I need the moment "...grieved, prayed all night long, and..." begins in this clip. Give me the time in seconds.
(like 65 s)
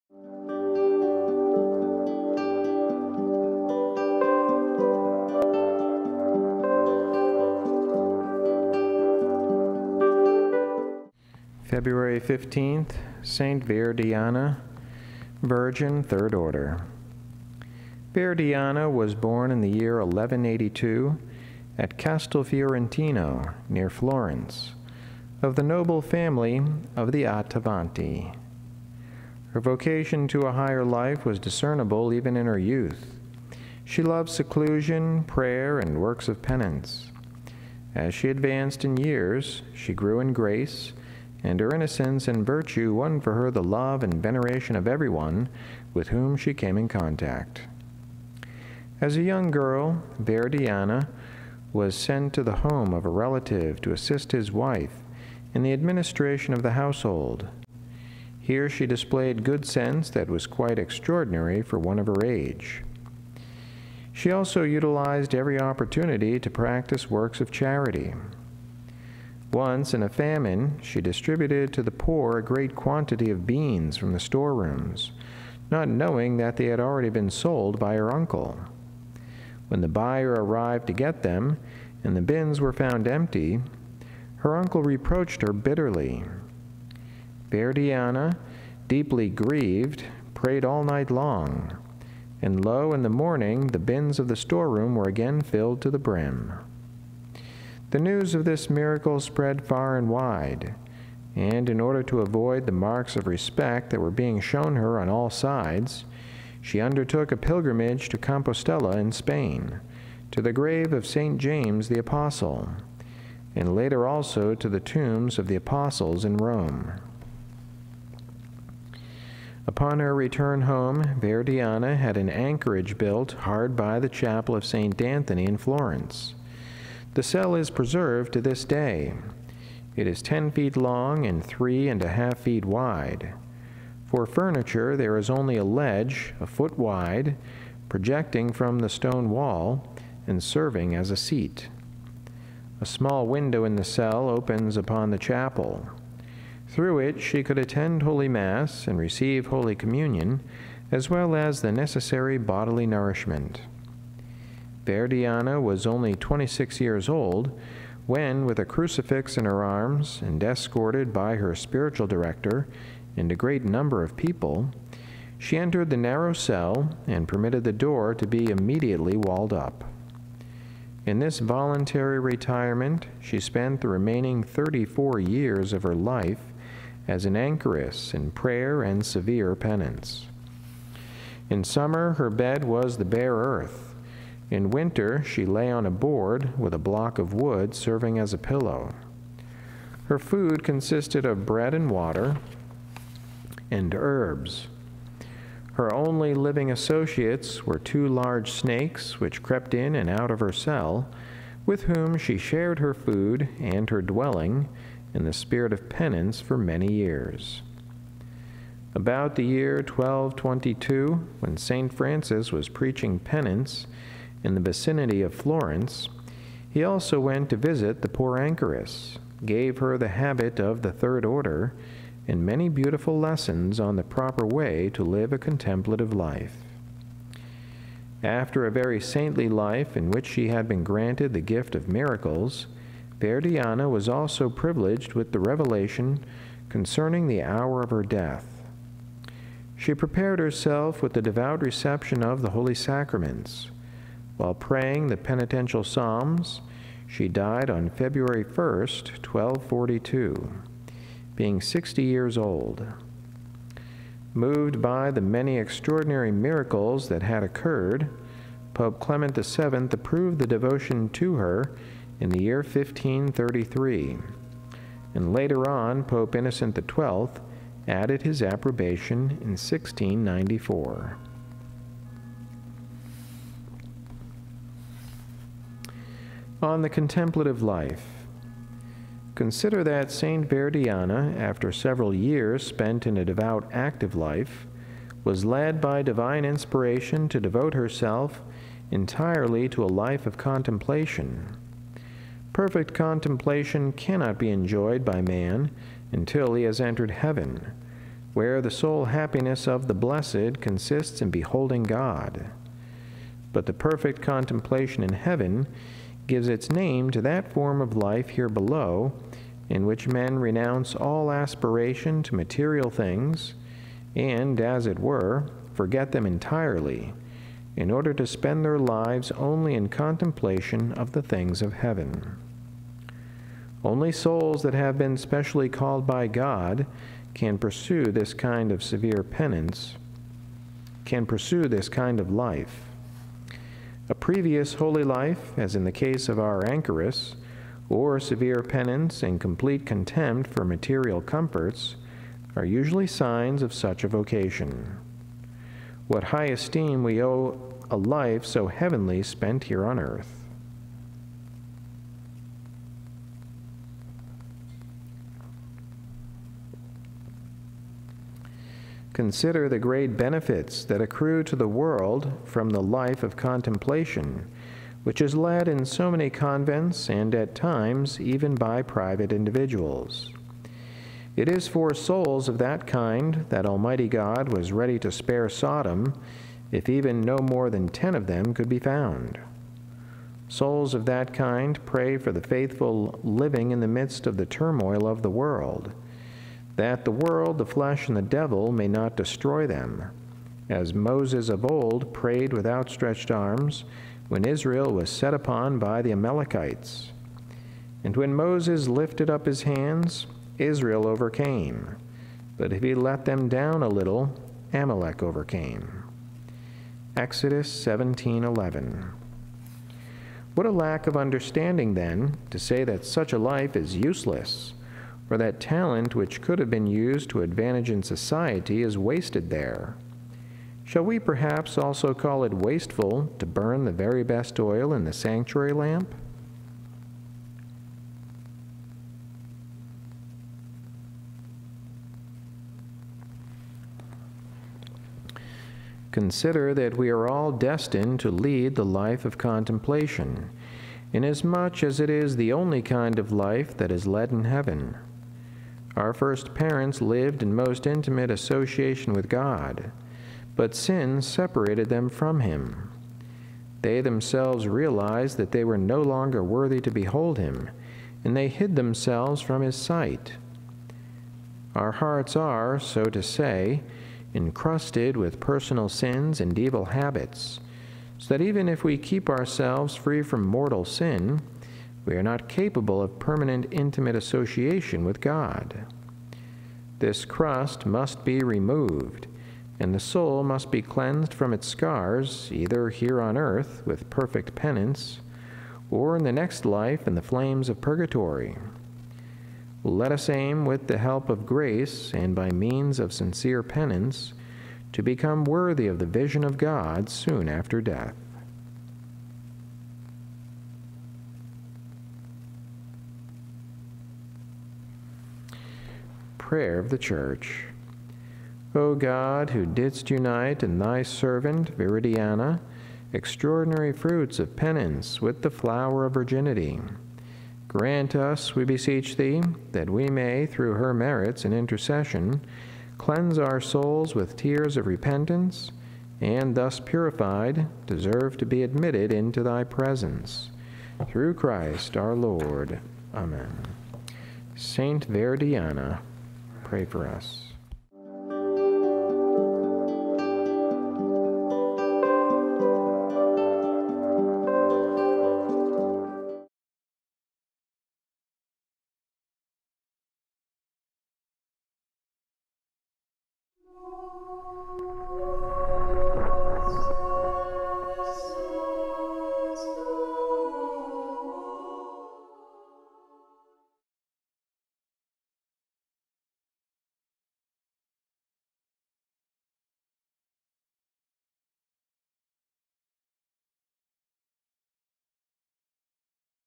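89 s.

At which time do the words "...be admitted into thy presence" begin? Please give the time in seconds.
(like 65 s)
528 s.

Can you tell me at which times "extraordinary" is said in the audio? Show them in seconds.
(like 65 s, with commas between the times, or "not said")
60 s, 255 s, 513 s.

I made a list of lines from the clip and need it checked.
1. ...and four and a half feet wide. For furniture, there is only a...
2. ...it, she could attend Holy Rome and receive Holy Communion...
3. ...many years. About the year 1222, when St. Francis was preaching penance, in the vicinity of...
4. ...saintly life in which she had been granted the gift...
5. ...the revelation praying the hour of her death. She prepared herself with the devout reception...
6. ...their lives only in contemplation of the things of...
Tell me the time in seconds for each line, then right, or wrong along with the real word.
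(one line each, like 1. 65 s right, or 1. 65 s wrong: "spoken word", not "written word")
1. 131 s wrong: "three", not "four"
2. 146 s wrong: "Mass", not "Rome"
3. 206 s right
4. 229 s right
5. 235 s wrong: "concerning", not "praying"
6. 318 s right.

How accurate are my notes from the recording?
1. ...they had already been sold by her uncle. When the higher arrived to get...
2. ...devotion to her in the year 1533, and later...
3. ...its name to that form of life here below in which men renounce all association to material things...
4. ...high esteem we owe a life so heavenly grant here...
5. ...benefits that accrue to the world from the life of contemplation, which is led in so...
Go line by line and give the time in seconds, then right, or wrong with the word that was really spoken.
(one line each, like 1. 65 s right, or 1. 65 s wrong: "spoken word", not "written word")
1. 76 s wrong: "buyer", not "higher"
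2. 260 s right
3. 306 s wrong: "aspiration", not "association"
4. 346 s wrong: "spent", not "grant"
5. 360 s right.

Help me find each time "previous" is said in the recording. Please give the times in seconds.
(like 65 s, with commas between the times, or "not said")
334 s.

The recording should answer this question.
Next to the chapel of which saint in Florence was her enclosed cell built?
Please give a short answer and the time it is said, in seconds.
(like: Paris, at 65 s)
St. Anthony, at 124 s.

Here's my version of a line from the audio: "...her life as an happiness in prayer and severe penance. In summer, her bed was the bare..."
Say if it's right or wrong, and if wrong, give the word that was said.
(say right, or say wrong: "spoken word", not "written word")
wrong: "anchoress", not "happiness".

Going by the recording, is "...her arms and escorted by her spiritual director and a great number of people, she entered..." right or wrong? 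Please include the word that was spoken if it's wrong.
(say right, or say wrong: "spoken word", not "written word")
right.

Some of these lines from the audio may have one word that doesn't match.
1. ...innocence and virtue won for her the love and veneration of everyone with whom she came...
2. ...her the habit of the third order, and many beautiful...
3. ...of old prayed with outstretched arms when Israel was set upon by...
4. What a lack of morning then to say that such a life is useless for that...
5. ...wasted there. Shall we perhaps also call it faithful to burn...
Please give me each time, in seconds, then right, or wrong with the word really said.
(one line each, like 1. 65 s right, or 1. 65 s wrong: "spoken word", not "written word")
1. 41 s right
2. 219 s right
3. 391 s right
4. 410 s wrong: "understanding", not "morning"
5. 418 s wrong: "wasteful", not "faithful".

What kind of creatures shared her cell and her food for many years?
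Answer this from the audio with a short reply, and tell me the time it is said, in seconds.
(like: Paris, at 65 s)
Two large snakes, at 197 s.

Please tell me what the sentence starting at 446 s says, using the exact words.
Our first parents lived in most intimate association with God, but sin separated them from Him.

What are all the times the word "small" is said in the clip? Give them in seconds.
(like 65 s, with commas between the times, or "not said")
142 s.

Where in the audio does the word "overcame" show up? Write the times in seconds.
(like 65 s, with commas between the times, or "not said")
401 s, 405 s.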